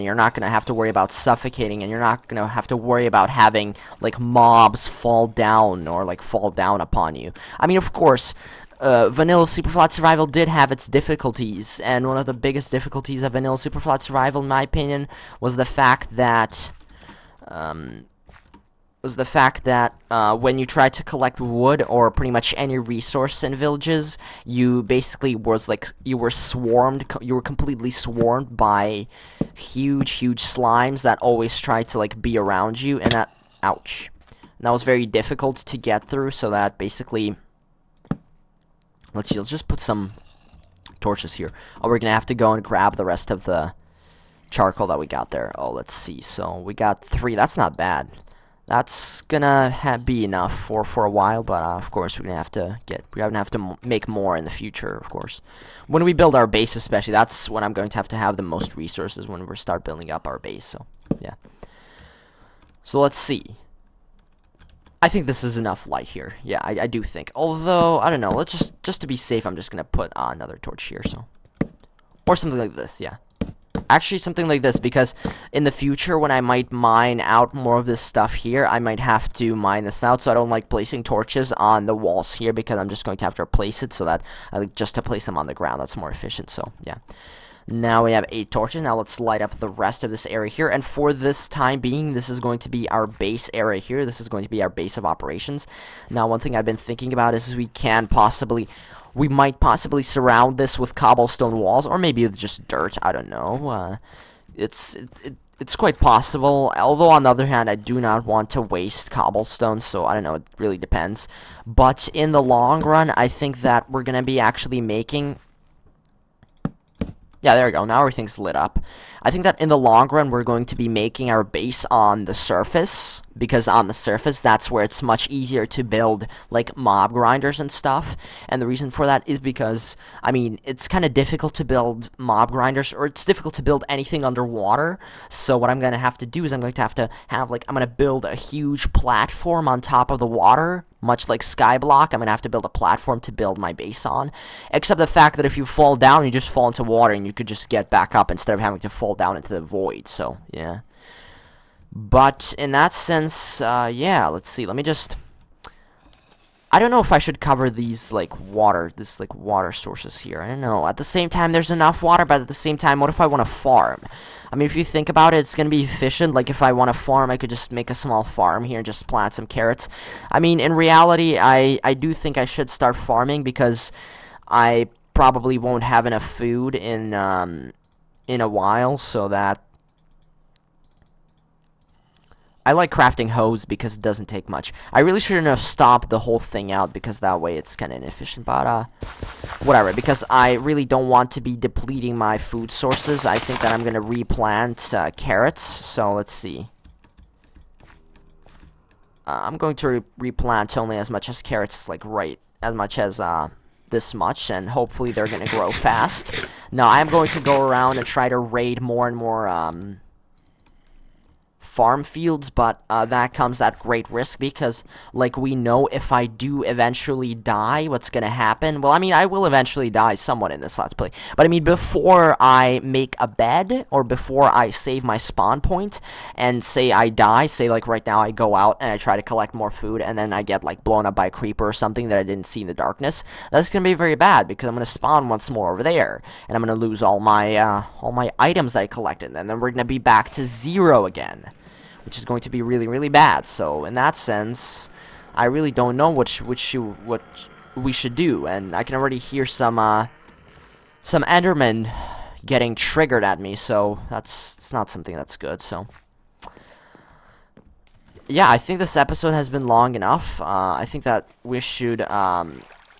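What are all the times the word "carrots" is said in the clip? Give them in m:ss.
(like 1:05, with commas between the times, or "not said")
2:49, 3:15, 3:21.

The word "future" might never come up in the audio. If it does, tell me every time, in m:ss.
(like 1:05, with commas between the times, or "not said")
0:54, 1:15.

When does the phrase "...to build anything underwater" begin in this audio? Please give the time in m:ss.
2:13.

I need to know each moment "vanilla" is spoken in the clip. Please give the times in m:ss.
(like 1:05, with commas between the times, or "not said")
0:09, 0:13.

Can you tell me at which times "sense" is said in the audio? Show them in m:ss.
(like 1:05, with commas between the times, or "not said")
2:32, 4:04.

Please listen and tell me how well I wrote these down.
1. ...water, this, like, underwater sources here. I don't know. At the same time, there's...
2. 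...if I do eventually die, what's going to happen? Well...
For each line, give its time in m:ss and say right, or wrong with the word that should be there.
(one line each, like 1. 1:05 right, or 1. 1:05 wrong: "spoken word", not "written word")
1. 2:38 wrong: "water", not "underwater"
2. 3:35 right.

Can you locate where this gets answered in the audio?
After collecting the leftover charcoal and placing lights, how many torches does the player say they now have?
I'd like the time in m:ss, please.
1:28.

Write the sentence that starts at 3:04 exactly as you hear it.
I really shouldn't have stopped the whole thing out because that way it's kind of inefficient, but uh, whatever.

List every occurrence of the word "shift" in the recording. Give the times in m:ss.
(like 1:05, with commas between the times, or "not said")
not said.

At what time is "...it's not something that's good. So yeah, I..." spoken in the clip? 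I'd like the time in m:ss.
4:14.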